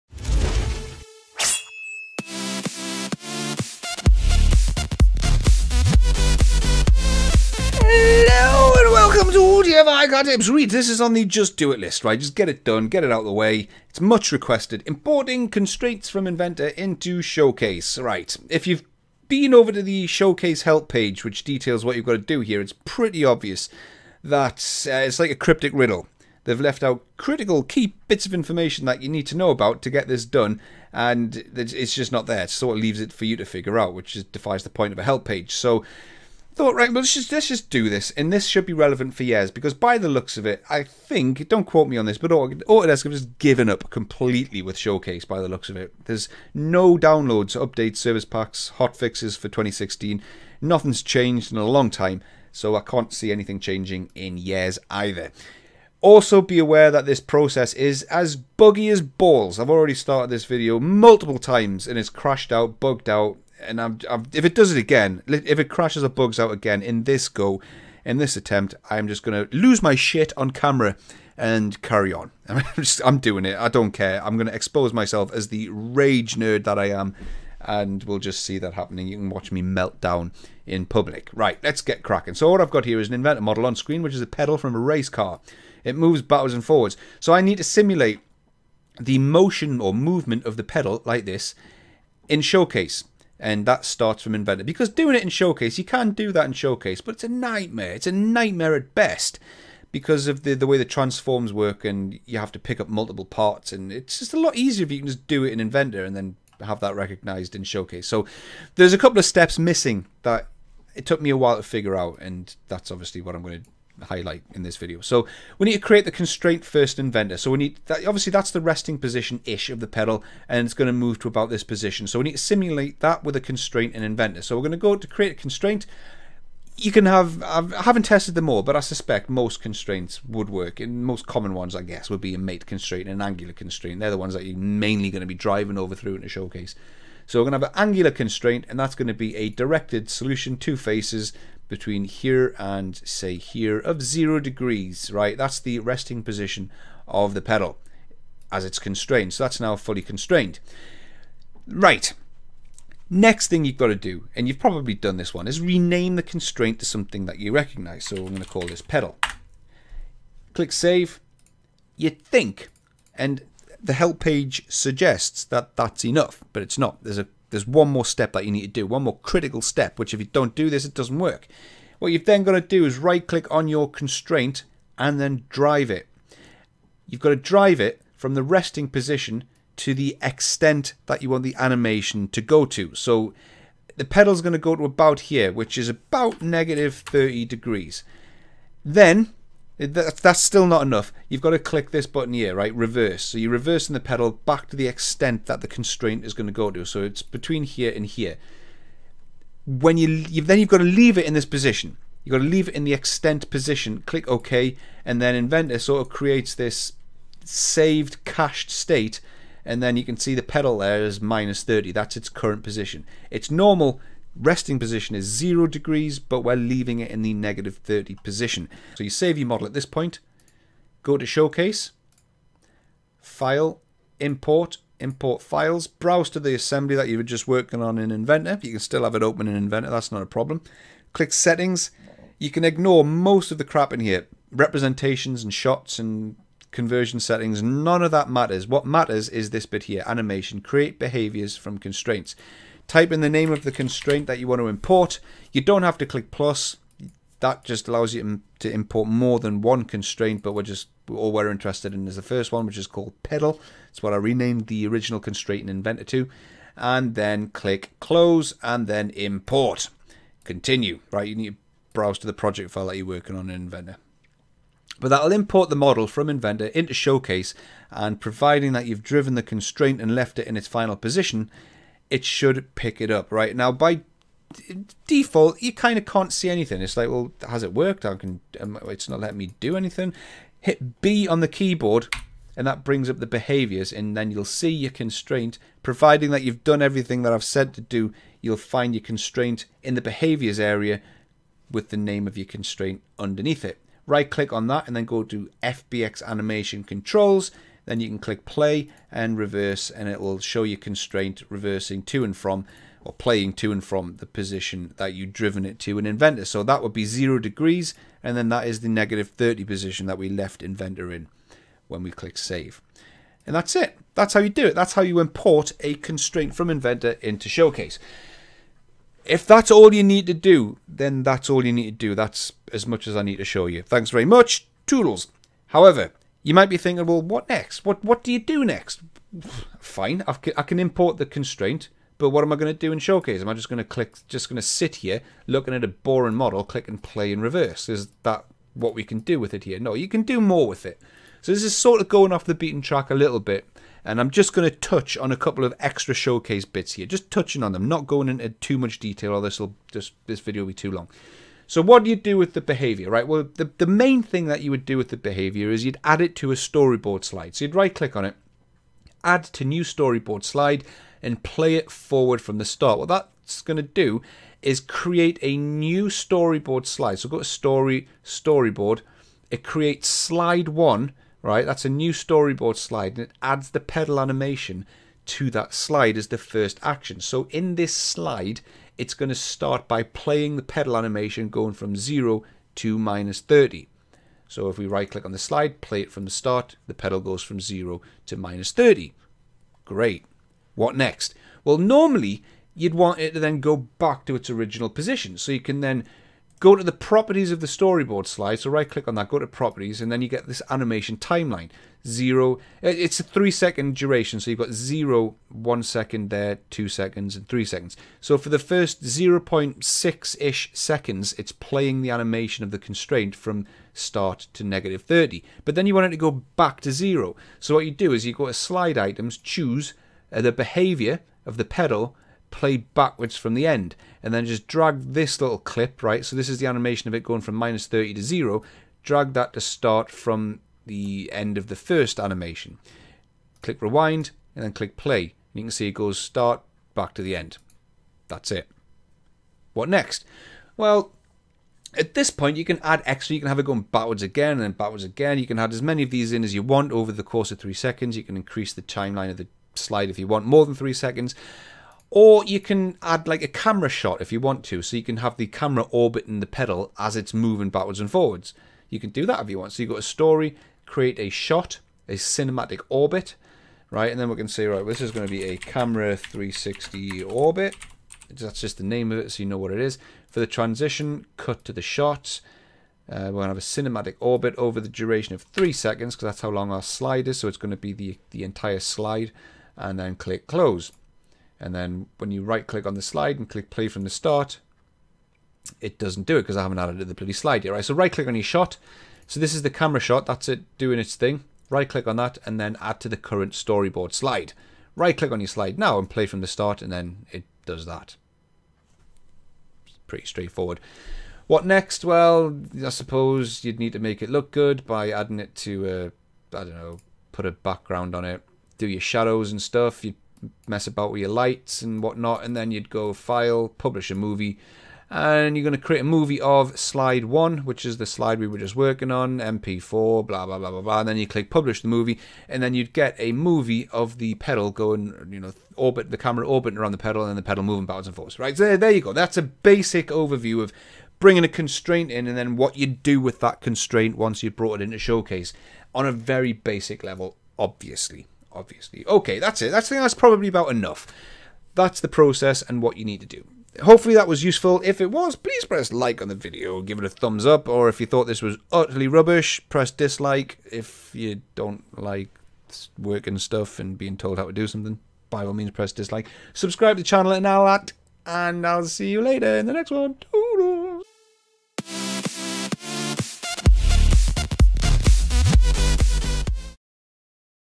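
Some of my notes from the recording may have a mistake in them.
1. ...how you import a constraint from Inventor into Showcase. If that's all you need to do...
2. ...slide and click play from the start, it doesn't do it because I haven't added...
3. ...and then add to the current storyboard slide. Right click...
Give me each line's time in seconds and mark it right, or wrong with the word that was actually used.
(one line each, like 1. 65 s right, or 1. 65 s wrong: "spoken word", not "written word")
1. 314 s right
2. 483 s right
3. 492 s right.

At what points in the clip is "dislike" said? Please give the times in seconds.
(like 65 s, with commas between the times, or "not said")
549 s, 555 s.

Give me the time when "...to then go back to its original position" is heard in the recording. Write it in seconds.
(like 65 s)
393 s.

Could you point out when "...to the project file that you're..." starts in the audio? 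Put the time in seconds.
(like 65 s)
262 s.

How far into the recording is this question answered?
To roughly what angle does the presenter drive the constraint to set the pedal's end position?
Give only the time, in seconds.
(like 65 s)
186 s.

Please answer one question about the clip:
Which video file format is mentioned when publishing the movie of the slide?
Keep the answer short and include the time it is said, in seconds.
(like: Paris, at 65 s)
MP4, at 519 s.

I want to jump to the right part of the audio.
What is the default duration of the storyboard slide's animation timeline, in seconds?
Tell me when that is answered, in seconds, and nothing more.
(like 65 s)
403 s.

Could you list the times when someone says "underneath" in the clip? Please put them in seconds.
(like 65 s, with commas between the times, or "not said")
293 s.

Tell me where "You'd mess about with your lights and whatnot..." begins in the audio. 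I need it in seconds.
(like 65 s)
510 s.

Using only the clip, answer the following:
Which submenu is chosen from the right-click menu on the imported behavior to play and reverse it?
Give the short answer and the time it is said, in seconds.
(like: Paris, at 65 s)
FBX animation controls, at 295 s.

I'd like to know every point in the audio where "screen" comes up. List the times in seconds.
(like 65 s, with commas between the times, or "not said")
83 s.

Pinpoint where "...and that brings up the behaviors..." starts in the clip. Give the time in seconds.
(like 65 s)
282 s.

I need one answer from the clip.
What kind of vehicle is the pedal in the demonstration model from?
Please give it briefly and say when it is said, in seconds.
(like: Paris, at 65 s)
Race car, at 84 s.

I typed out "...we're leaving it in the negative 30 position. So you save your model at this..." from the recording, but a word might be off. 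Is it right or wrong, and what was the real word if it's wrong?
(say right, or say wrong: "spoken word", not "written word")
right.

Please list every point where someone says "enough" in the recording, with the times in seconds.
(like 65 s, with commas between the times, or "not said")
166 s, 190 s, 540 s.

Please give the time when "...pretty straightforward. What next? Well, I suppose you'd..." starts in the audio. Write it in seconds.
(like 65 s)
500 s.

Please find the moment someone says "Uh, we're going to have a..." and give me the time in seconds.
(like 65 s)
473 s.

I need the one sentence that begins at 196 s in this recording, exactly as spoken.
So it's between here and here.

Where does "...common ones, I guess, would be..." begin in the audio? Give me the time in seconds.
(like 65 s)
131 s.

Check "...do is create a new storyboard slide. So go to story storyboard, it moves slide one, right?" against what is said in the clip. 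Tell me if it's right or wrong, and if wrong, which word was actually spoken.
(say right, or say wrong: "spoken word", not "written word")
wrong: "creates", not "moves".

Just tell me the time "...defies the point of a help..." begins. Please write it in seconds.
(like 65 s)
34 s.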